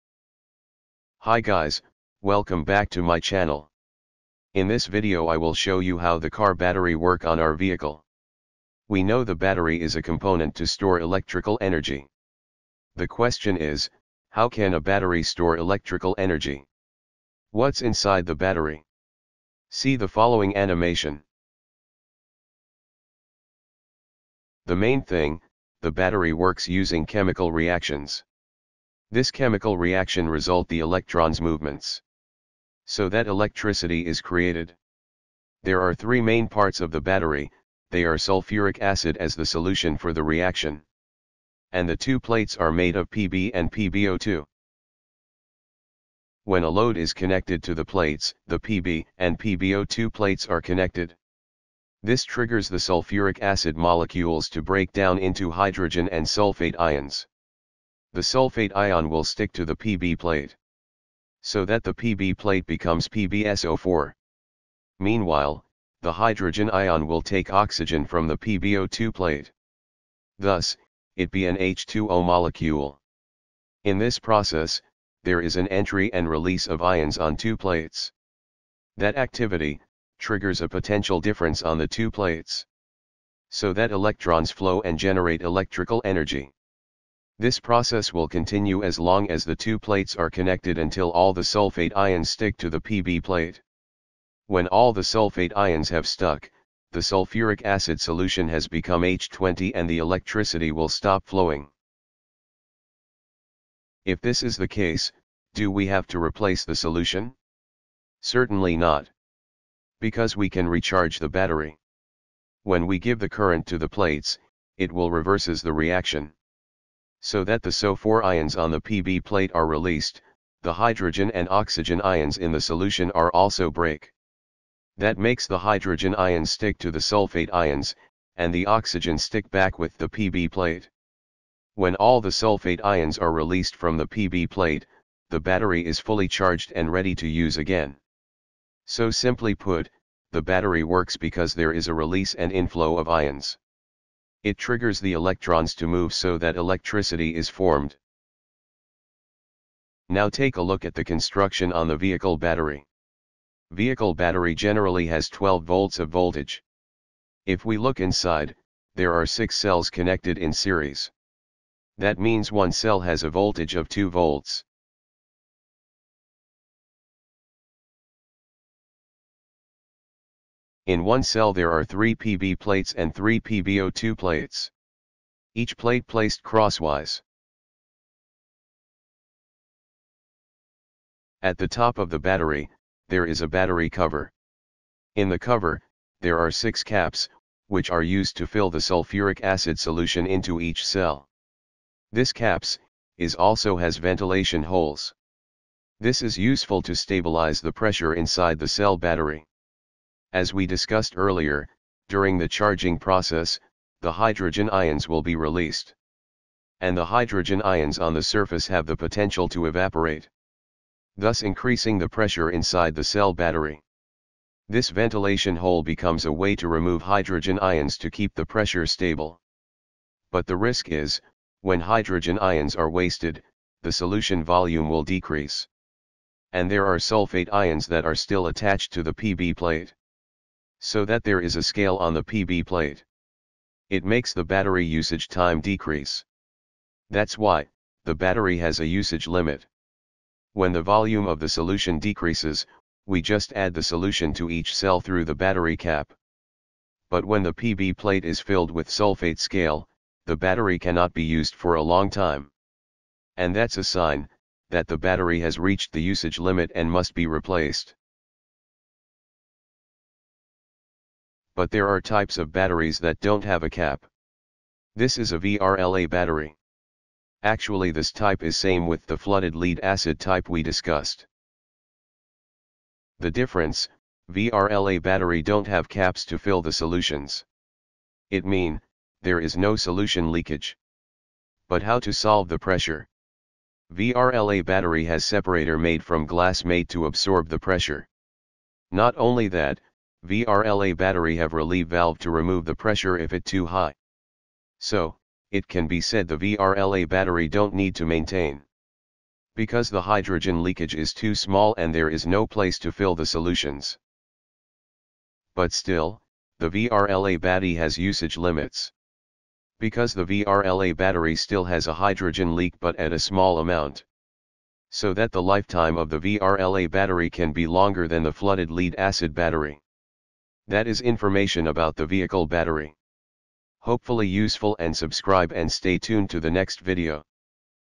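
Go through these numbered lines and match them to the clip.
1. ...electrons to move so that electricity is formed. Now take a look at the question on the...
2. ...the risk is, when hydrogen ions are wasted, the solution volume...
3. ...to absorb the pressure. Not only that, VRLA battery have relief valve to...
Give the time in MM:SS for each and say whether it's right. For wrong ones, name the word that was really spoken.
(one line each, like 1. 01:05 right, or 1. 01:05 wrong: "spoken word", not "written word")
1. 02:25 wrong: "construction", not "question"
2. 03:40 right
3. 04:46 right.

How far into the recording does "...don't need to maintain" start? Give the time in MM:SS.
04:57.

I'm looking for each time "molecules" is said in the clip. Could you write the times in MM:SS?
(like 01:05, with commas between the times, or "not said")
00:53, 01:12.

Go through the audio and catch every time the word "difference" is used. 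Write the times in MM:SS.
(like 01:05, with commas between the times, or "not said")
01:21, 04:33.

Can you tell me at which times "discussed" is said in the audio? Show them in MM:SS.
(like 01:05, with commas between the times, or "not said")
03:20, 04:30.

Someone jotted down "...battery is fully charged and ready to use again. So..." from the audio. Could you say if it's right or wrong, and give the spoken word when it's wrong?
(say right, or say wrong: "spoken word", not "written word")
right.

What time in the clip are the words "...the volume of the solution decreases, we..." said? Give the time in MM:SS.
04:00.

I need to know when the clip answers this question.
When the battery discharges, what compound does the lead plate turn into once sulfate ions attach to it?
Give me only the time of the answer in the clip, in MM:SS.
01:03.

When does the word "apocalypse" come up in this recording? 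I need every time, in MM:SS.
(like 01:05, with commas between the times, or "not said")
not said.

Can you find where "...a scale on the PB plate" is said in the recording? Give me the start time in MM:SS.
03:51.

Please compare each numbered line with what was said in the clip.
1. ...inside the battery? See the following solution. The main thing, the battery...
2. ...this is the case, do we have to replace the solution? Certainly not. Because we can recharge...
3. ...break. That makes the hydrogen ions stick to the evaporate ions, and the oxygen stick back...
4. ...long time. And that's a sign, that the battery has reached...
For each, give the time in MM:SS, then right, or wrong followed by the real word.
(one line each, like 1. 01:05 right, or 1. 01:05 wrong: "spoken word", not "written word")
1. 00:17 wrong: "animation", not "solution"
2. 01:44 right
3. 02:03 wrong: "sulfate", not "evaporate"
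4. 04:11 right.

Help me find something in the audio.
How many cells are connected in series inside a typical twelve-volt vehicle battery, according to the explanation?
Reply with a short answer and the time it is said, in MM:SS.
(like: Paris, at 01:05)
6, at 02:39.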